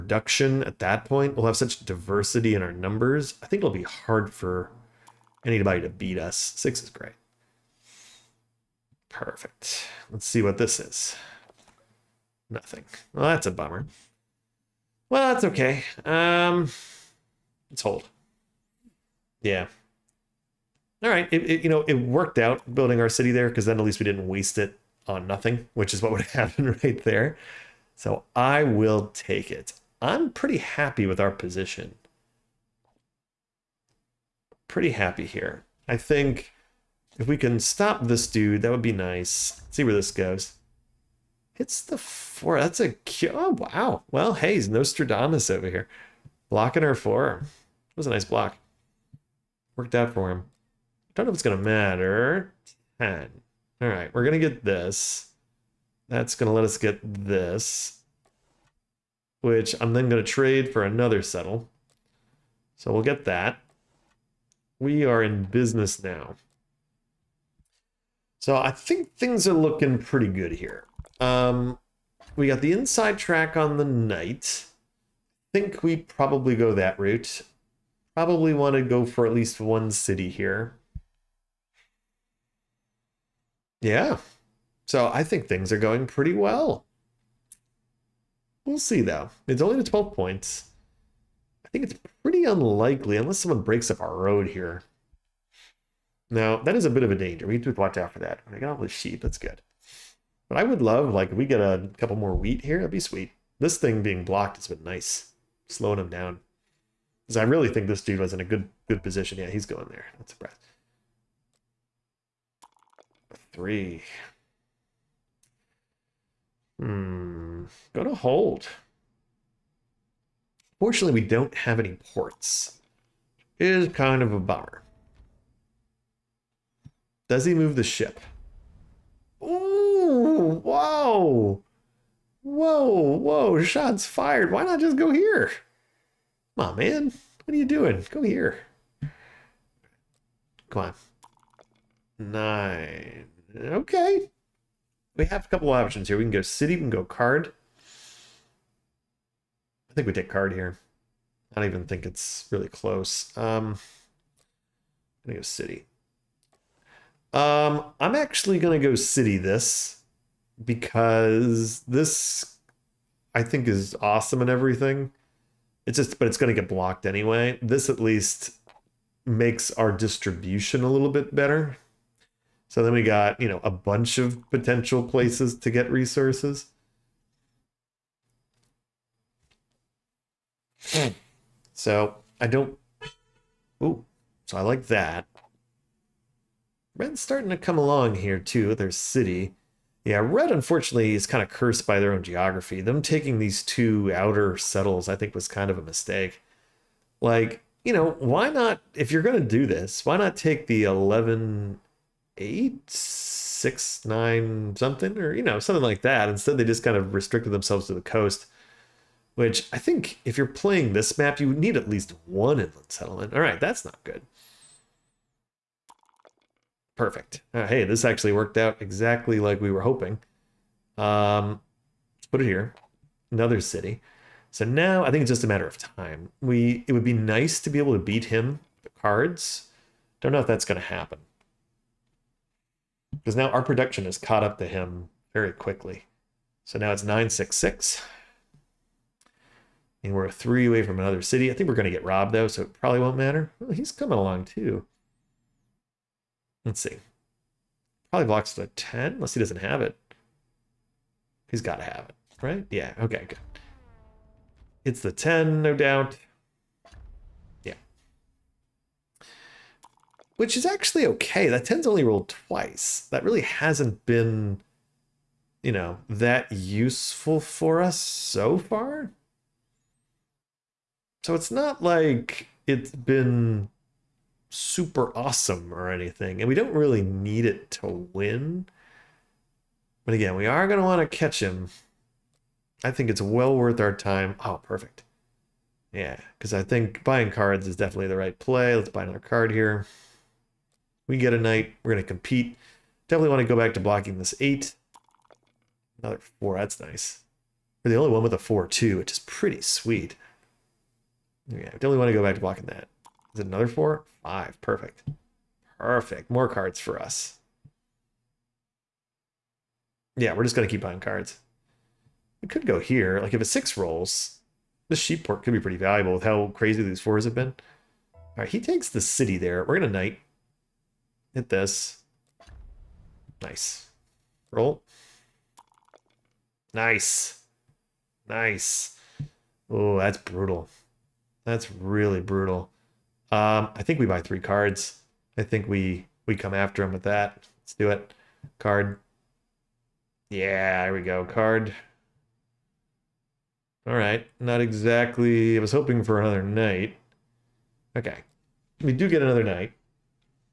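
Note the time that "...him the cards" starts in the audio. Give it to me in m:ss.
3:48.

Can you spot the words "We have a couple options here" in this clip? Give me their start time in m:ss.
2:25.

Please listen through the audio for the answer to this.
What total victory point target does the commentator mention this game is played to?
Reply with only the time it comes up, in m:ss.
1:29.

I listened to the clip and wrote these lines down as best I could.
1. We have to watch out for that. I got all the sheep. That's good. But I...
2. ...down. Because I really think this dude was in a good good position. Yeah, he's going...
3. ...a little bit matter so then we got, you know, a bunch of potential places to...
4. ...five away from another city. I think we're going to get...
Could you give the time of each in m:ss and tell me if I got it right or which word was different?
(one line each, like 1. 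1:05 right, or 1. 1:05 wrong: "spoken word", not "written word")
1. 1:37 right
2. 1:46 right
3. 2:50 wrong: "better", not "matter"
4. 4:00 wrong: "three", not "five".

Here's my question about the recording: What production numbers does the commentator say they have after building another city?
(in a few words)
966.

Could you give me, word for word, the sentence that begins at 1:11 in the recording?
Um, we got the inside track on the knight.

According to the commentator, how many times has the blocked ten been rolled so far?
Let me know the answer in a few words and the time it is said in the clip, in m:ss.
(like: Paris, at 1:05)
twice, at 4:22.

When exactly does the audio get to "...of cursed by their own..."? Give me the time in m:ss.
3:11.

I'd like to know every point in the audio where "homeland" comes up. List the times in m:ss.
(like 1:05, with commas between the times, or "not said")
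not said.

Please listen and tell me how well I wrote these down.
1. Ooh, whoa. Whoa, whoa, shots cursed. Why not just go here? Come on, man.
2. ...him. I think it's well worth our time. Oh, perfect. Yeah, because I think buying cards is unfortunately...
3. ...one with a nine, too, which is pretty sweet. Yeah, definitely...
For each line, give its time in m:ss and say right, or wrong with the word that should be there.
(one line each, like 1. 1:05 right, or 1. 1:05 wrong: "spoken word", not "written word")
1. 2:09 wrong: "fired", not "cursed"
2. 4:41 wrong: "definitely", not "unfortunately"
3. 4:58 wrong: "four", not "nine".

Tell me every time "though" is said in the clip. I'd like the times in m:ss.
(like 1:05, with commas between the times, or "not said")
1:29, 4:02.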